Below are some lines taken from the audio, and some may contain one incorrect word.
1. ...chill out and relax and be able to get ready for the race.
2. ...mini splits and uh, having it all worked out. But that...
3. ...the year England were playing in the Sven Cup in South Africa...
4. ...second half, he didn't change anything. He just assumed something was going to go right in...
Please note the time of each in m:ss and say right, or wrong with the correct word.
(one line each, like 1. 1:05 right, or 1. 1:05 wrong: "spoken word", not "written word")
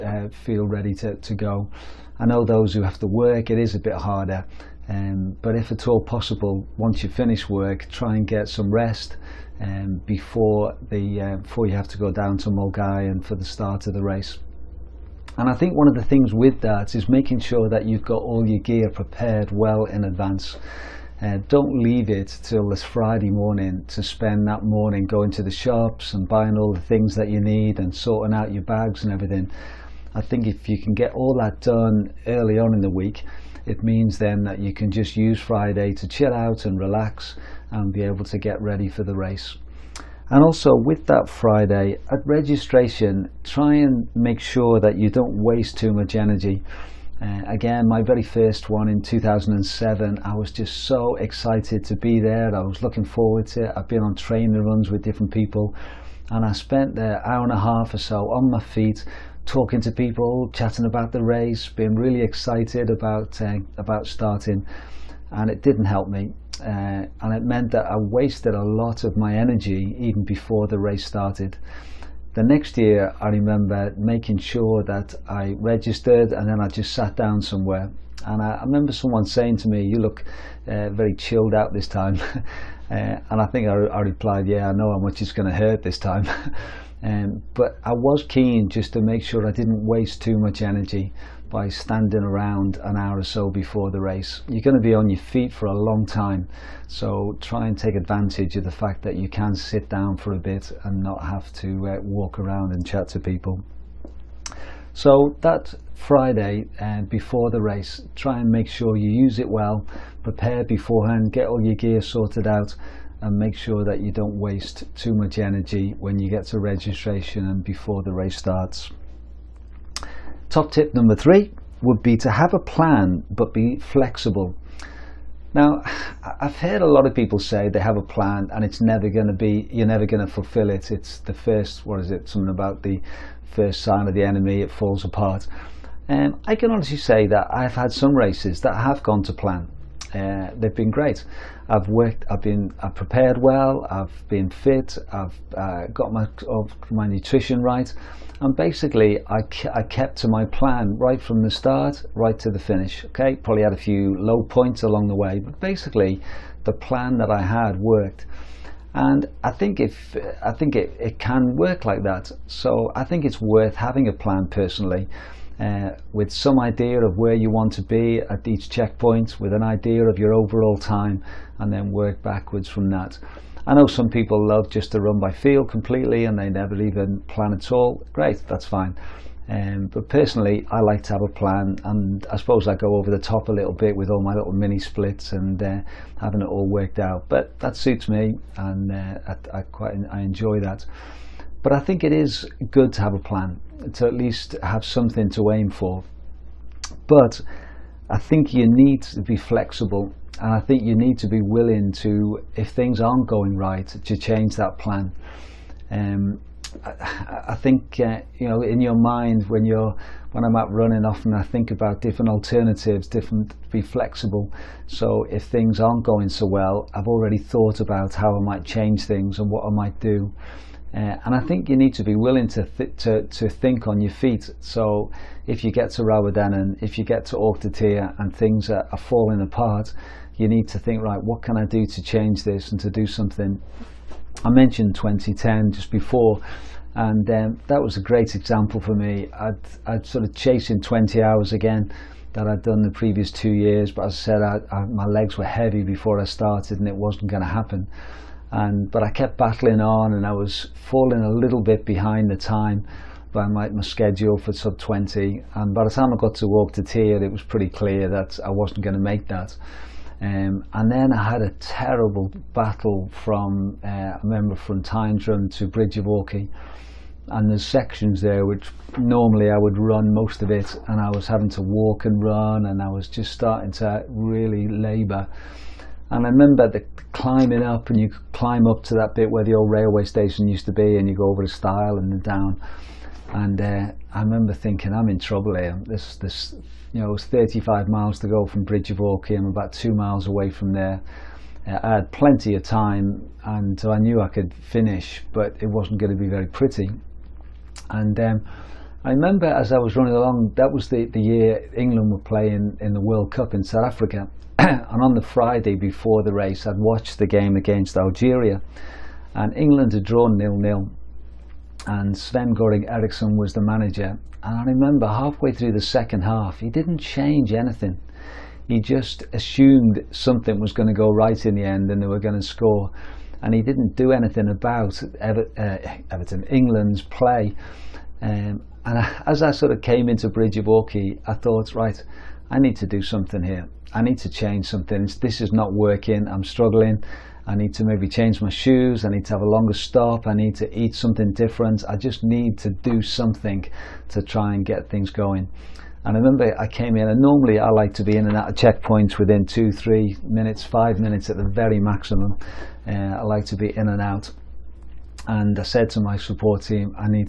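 1. 0:36 right
2. 3:04 right
3. 5:01 wrong: "World", not "Sven"
4. 5:15 right.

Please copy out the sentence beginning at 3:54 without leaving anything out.
I mentioned 2010 just before, and um, that was a great example for me.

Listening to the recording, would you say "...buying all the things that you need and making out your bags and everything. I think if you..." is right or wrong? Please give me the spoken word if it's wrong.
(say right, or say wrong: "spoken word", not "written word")
wrong: "sorting", not "making".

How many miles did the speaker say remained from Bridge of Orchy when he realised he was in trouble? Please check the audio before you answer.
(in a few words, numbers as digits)
35.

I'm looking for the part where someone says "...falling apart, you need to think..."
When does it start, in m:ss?
3:48.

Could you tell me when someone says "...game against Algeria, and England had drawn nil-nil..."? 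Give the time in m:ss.
5:07.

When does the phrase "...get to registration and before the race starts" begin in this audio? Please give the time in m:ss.
1:56.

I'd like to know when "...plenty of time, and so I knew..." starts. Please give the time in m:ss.
4:52.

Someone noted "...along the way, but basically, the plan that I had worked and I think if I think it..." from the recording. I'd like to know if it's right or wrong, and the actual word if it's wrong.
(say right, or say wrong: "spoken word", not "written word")
right.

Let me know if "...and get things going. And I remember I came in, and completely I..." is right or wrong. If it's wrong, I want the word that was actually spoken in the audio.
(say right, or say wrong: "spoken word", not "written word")
wrong: "normally", not "completely".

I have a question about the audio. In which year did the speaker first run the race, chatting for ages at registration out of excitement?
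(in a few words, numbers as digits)
2007.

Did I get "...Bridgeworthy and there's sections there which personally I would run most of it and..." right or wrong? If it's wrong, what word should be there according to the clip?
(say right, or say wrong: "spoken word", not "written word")
wrong: "normally", not "personally".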